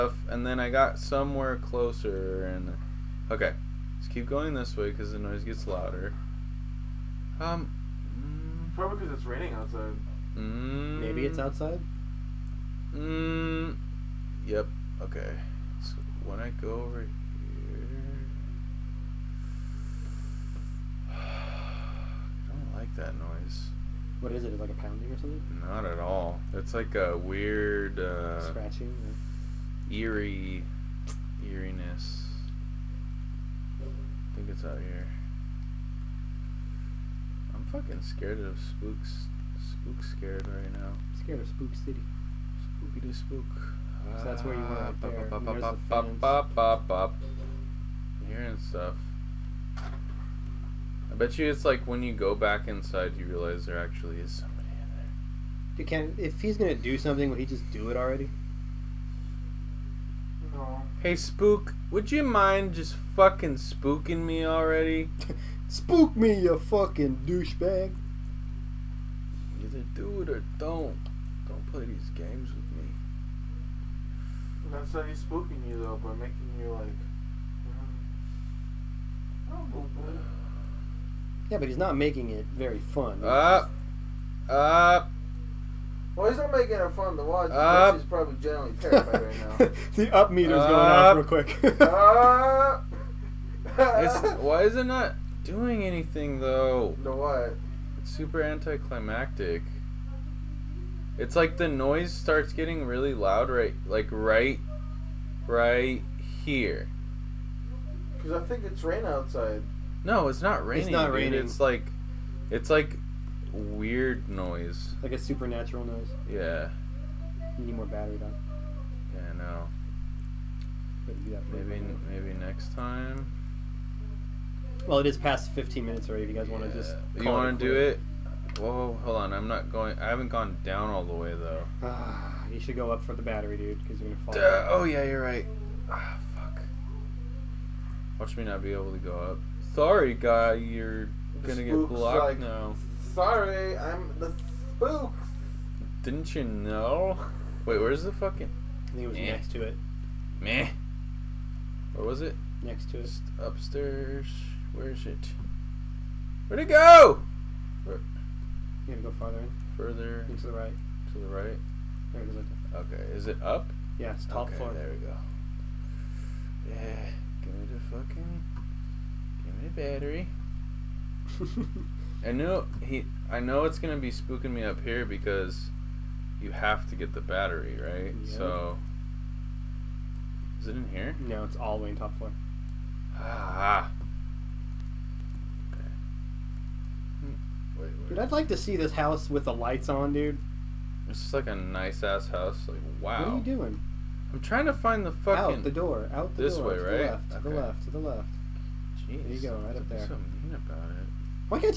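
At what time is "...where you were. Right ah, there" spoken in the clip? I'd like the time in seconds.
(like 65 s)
44 s.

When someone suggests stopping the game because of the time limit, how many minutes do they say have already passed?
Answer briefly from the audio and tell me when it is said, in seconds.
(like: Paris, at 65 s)
15, at 125 s.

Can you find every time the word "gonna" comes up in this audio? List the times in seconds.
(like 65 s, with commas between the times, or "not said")
56 s, 134 s, 141 s, 173 s.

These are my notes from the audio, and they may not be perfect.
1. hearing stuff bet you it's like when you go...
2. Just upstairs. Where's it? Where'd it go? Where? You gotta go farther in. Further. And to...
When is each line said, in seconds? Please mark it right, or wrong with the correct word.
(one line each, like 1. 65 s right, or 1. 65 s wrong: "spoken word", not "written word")
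1. 48 s right
2. 153 s right.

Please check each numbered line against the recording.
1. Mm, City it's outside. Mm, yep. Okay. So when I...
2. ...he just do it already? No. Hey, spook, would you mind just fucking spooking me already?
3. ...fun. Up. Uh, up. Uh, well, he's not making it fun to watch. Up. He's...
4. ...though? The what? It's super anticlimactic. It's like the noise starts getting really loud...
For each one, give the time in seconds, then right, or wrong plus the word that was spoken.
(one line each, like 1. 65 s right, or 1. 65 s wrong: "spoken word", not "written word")
1. 10 s wrong: "Maybe", not "City"
2. 57 s right
3. 82 s right
4. 96 s right.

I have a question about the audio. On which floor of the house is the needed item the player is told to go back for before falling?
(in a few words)
Top floor.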